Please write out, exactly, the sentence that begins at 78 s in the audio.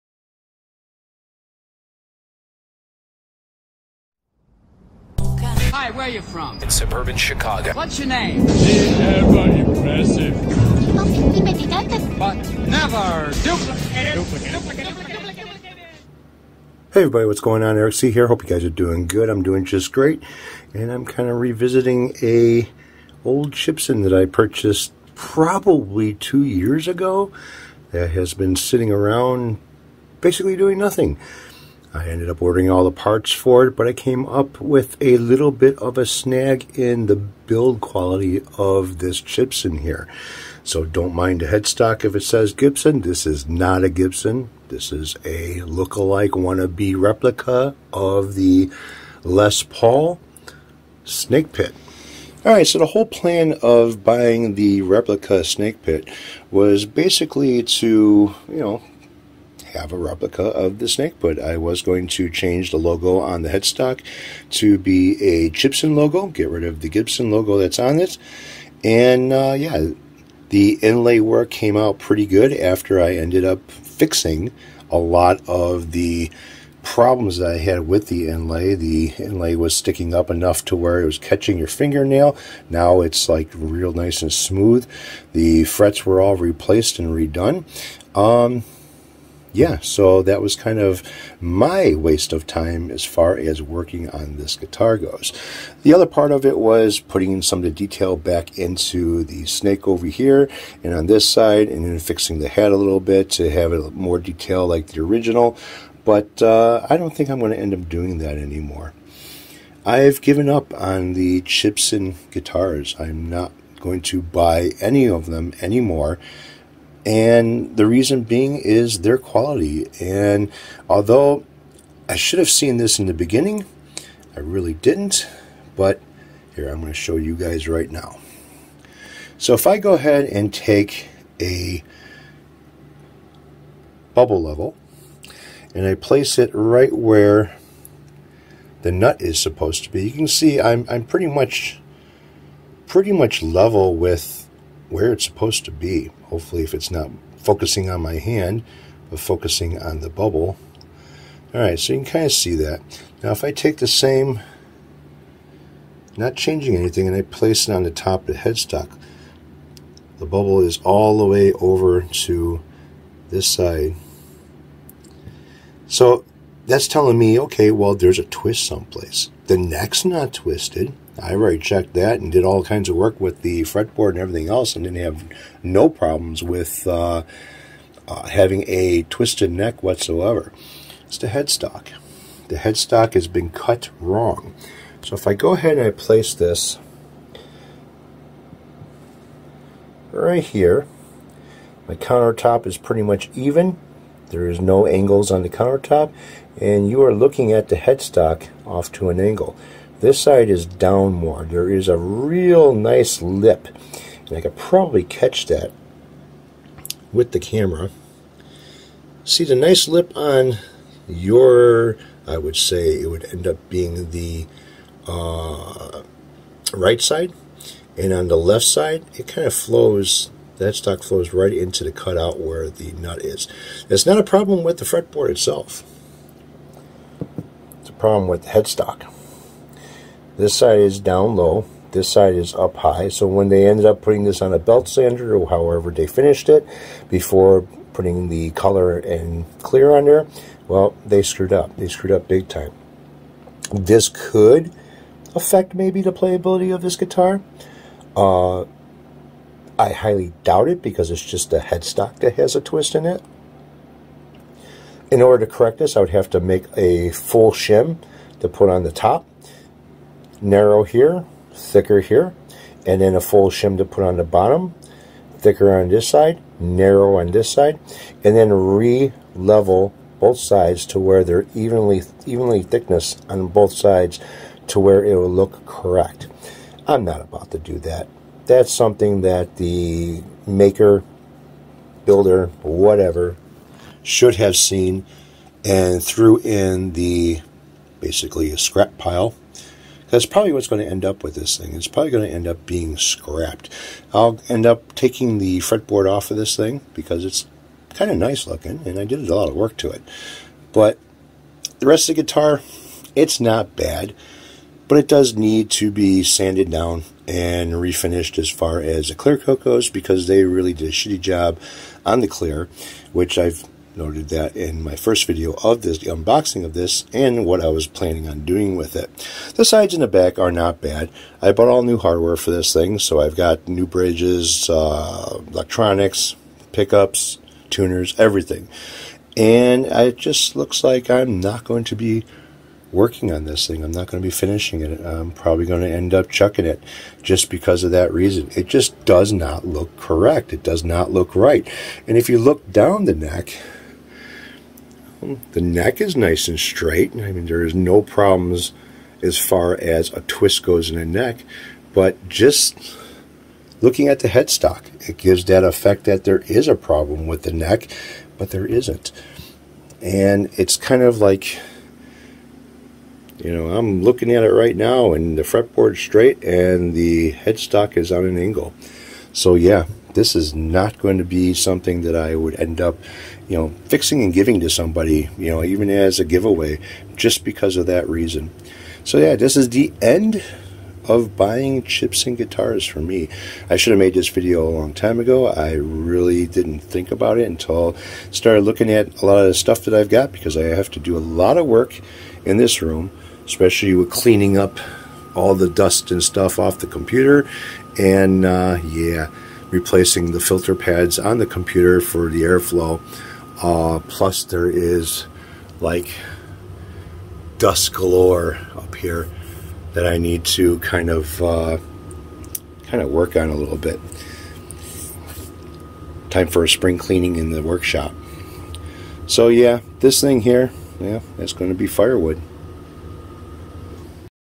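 The inlay was sticking up enough to where it was catching your fingernail.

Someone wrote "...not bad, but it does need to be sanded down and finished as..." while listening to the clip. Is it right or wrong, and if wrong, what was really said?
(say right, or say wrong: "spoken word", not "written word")
wrong: "refinished", not "finished".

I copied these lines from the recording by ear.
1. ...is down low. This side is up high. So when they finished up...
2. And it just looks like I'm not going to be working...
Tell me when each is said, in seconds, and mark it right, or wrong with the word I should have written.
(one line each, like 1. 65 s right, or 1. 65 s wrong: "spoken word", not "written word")
1. 230 s wrong: "ended", not "finished"
2. 329 s right.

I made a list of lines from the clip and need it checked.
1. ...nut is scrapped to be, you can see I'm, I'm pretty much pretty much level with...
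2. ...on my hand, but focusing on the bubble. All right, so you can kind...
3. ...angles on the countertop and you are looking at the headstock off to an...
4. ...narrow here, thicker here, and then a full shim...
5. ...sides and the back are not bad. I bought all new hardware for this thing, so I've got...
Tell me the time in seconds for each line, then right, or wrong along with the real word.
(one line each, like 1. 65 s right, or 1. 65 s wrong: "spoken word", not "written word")
1. 138 s wrong: "supposed", not "scrapped"
2. 147 s right
3. 194 s right
4. 260 s right
5. 319 s right.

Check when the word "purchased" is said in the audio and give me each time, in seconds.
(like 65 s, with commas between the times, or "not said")
24 s.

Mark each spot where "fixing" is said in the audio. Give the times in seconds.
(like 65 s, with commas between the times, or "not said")
73 s, 101 s, 373 s.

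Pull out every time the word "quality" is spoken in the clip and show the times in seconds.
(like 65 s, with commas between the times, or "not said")
37 s, 119 s.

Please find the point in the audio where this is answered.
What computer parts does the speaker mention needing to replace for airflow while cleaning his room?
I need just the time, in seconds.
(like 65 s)
400 s.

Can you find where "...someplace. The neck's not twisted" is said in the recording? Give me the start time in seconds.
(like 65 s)
168 s.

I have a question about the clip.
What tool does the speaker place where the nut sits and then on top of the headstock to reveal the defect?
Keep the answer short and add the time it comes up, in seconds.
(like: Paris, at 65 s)
Bubble level, at 134 s.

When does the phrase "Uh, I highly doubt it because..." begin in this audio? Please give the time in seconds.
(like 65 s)
248 s.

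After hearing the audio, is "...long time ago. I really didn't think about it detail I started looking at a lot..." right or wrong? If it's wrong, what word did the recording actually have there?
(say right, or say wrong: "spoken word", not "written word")
wrong: "until", not "detail".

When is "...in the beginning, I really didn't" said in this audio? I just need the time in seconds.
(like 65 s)
122 s.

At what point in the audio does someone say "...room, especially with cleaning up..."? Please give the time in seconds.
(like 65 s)
392 s.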